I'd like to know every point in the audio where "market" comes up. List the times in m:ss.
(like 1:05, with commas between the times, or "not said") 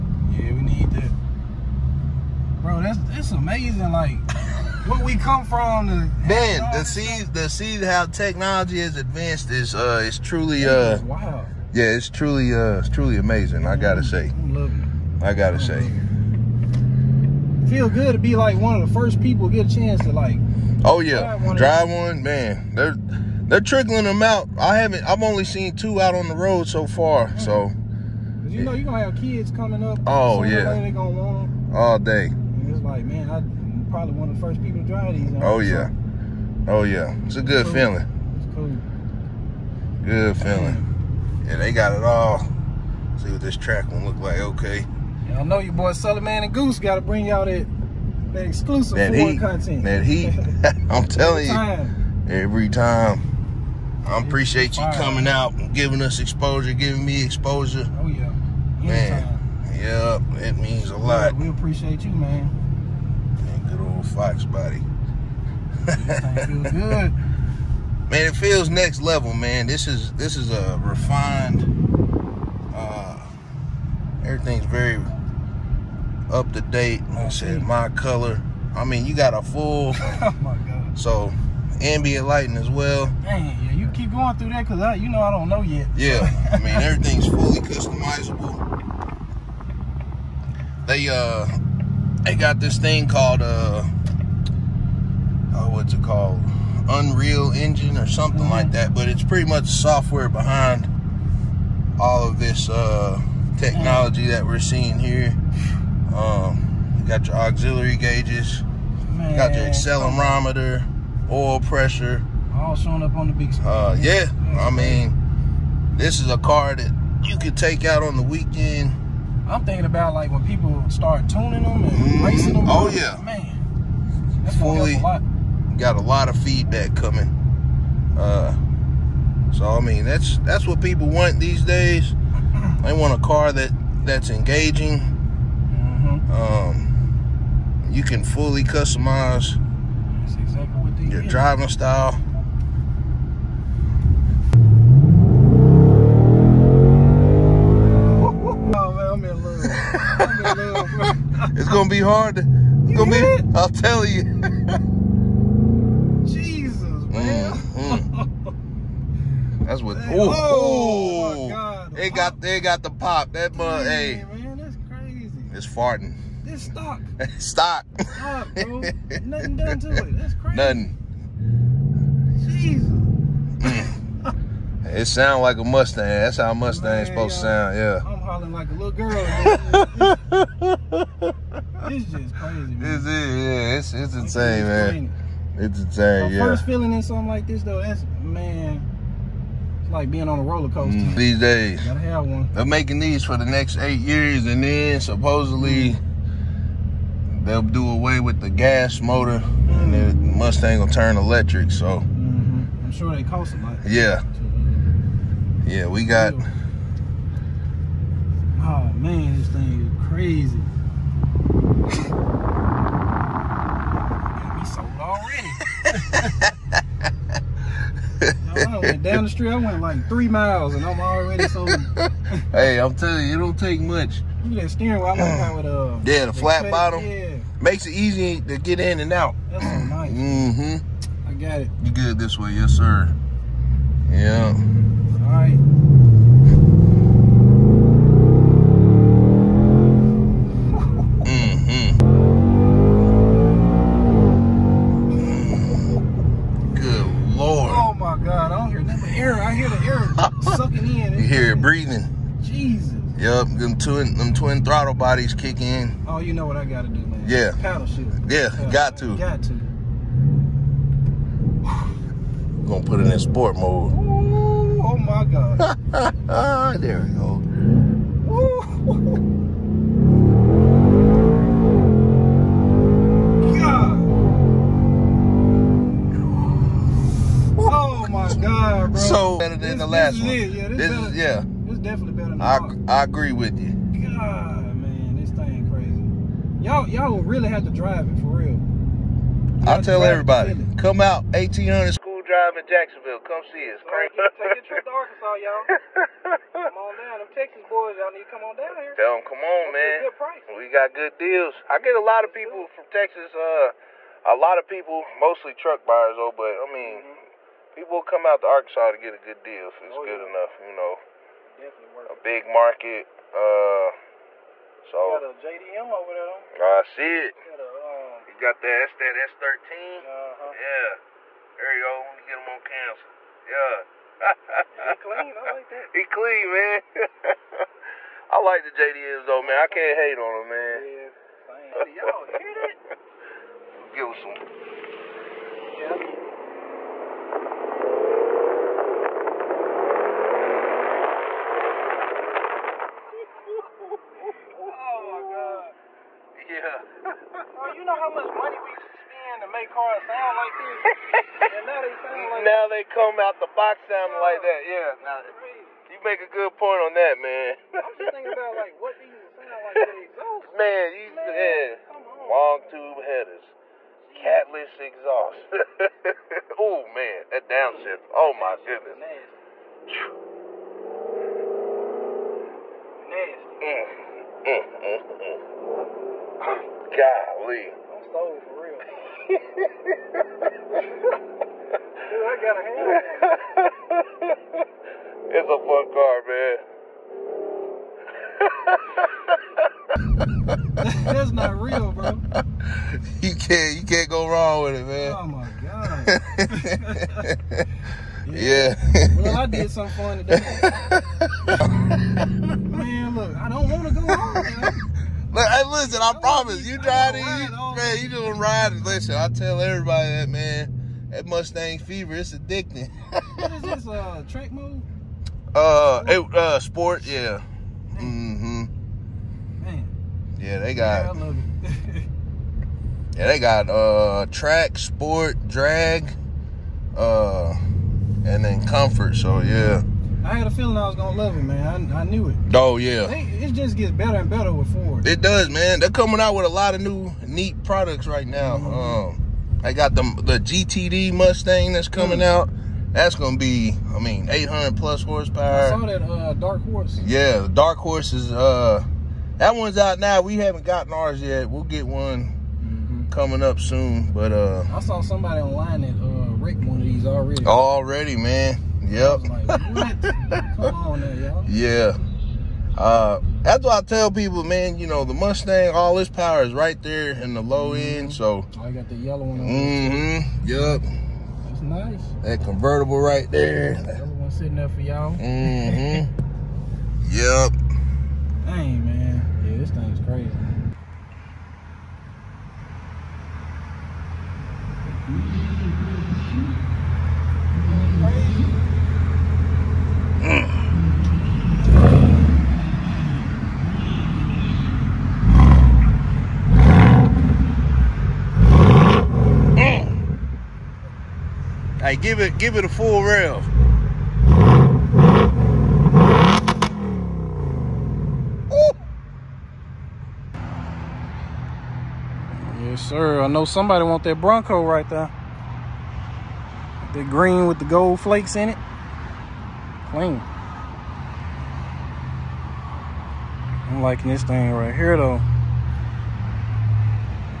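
5:12.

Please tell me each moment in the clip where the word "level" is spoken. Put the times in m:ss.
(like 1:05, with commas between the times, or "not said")
1:09.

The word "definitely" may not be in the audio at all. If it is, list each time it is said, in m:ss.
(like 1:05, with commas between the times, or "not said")
4:41, 5:11.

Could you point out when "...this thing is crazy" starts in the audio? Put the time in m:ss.
3:29.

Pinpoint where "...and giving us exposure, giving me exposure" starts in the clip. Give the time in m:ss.
0:55.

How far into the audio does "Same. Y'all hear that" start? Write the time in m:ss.
5:31.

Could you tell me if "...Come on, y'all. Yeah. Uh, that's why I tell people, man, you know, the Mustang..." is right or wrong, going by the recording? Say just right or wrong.
right.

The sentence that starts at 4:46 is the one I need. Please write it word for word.
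Y'all, y'all will really have to drive it for real.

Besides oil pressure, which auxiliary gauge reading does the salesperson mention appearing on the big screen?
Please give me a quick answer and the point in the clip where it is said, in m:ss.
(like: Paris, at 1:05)
accelerometer, at 1:49.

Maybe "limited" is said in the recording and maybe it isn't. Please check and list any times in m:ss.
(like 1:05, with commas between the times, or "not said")
not said.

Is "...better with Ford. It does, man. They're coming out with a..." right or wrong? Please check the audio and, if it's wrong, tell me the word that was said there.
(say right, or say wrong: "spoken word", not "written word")
right.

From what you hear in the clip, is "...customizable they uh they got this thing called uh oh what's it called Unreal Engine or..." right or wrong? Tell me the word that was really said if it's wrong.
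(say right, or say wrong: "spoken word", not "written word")
right.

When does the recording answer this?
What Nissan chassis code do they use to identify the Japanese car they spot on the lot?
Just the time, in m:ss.
5:19.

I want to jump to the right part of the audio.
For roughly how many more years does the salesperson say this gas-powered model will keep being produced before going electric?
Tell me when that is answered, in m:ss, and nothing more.
3:13.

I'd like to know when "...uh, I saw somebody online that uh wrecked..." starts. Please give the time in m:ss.
7:34.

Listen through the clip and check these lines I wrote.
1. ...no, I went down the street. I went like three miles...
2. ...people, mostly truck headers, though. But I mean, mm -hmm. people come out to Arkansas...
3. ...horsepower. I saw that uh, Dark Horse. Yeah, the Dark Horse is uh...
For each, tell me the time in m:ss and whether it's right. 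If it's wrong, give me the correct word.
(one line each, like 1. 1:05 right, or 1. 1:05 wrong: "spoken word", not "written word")
1. 3:38 right
2. 5:04 wrong: "buyers", not "headers"
3. 7:25 right.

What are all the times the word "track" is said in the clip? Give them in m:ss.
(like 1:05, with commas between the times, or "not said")
0:43, 6:54, 7:04.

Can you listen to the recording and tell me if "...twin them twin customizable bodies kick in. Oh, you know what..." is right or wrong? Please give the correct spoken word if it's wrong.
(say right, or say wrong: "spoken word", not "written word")
wrong: "throttle", not "customizable".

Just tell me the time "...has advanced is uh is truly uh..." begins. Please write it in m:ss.
0:08.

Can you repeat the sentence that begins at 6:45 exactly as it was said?
Look, hey, listen, I, I promise.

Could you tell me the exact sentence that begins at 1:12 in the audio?
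Uh, everything's very up to date.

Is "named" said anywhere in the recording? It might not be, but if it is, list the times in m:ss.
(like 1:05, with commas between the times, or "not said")
not said.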